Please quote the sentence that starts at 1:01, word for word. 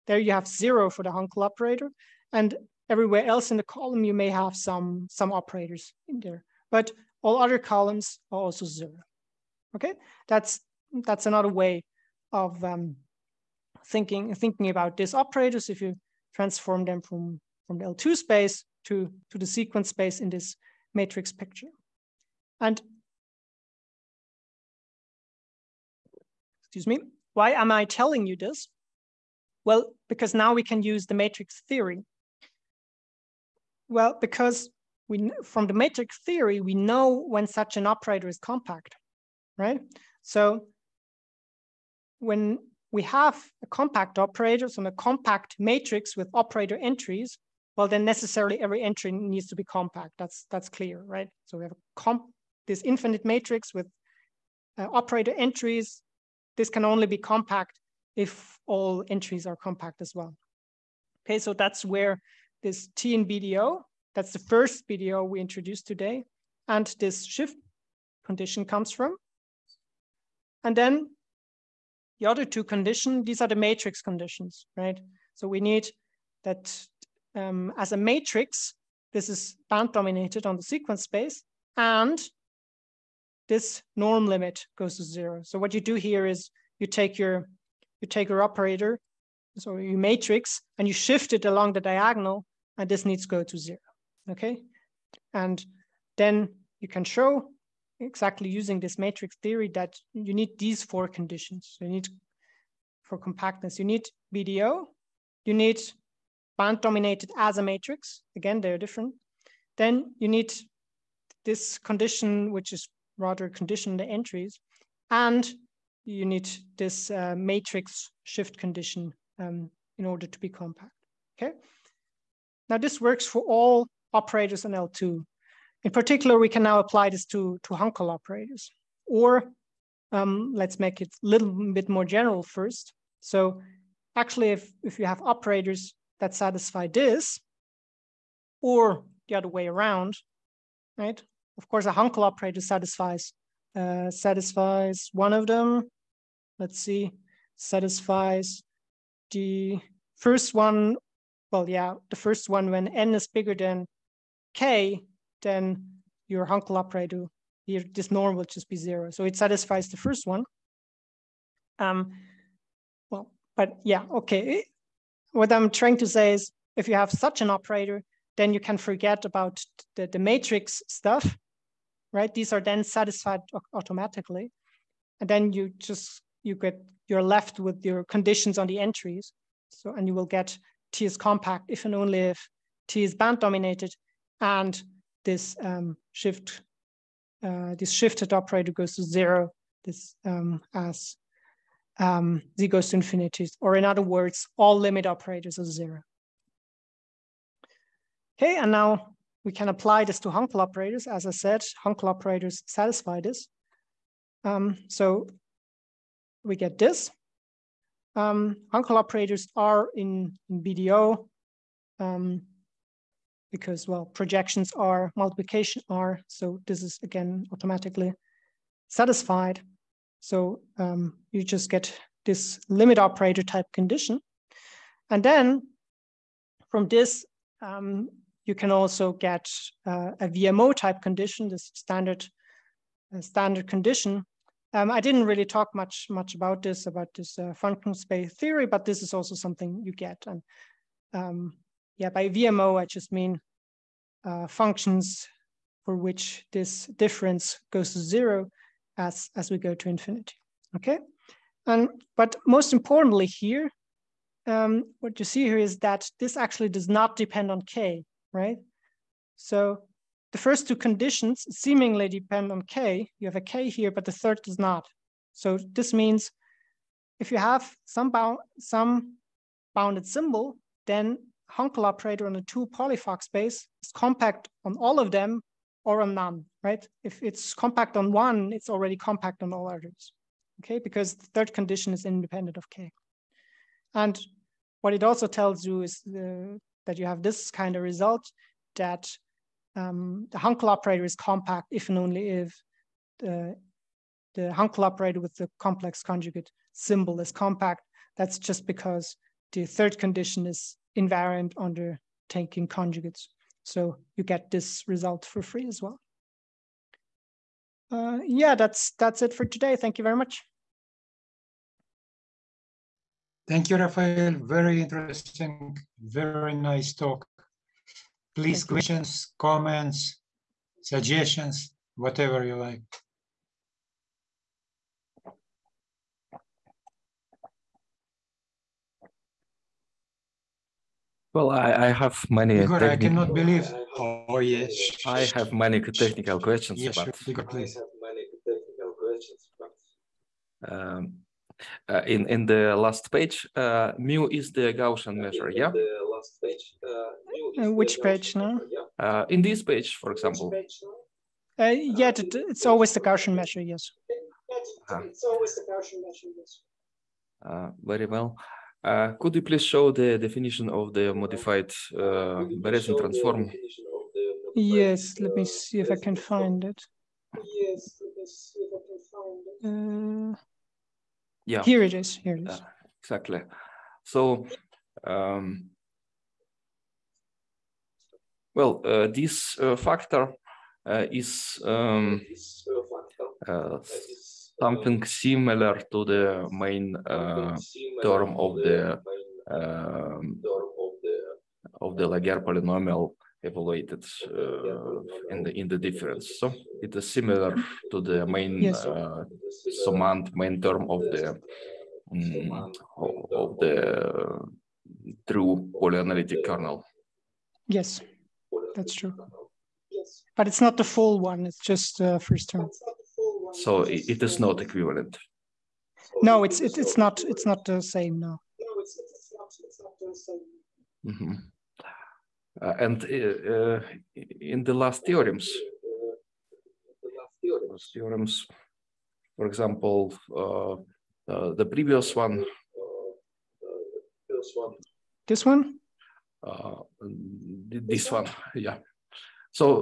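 Okay, so that's where this T in BDO, that's the first BDO we introduced today, and this shift condition comes from.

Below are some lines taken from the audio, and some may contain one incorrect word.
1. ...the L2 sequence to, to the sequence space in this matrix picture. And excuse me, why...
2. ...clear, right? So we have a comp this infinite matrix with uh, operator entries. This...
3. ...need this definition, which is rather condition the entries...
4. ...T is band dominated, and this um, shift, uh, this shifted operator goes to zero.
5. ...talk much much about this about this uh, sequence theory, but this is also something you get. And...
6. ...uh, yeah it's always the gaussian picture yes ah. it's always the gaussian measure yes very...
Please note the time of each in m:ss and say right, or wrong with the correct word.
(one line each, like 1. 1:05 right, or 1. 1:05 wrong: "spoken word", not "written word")
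1. 0:17 wrong: "space", not "sequence"
2. 0:50 right
3. 1:50 wrong: "condition", not "definition"
4. 3:02 right
5. 3:55 wrong: "space", not "sequence"
6. 5:51 wrong: "measure", not "picture".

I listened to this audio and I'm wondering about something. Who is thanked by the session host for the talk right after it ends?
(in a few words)
Rafael.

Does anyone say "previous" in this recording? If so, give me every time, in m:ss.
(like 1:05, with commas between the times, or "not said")
7:11.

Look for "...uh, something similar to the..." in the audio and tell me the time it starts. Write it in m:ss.
6:23.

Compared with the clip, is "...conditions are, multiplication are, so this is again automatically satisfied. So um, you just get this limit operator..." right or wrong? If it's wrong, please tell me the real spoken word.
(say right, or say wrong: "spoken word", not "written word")
wrong: "projections", not "conditions".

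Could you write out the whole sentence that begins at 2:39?
So it satisfies the first one.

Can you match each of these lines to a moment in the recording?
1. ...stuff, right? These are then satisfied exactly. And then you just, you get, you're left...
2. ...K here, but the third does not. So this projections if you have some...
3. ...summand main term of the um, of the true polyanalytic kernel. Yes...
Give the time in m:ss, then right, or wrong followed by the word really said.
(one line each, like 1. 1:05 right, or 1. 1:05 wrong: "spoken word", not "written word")
1. 2:50 wrong: "automatically", not "exactly"
2. 4:23 wrong: "means", not "projections"
3. 6:39 right.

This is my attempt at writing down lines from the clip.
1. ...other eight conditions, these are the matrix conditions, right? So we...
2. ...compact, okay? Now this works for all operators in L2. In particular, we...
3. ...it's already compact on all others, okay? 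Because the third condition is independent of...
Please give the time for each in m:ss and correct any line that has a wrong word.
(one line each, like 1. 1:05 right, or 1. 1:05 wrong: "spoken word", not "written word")
1. 1:12 wrong: "two", not "eight"
2. 2:00 right
3. 4:38 right.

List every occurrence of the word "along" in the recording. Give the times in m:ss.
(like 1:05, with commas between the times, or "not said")
1:31.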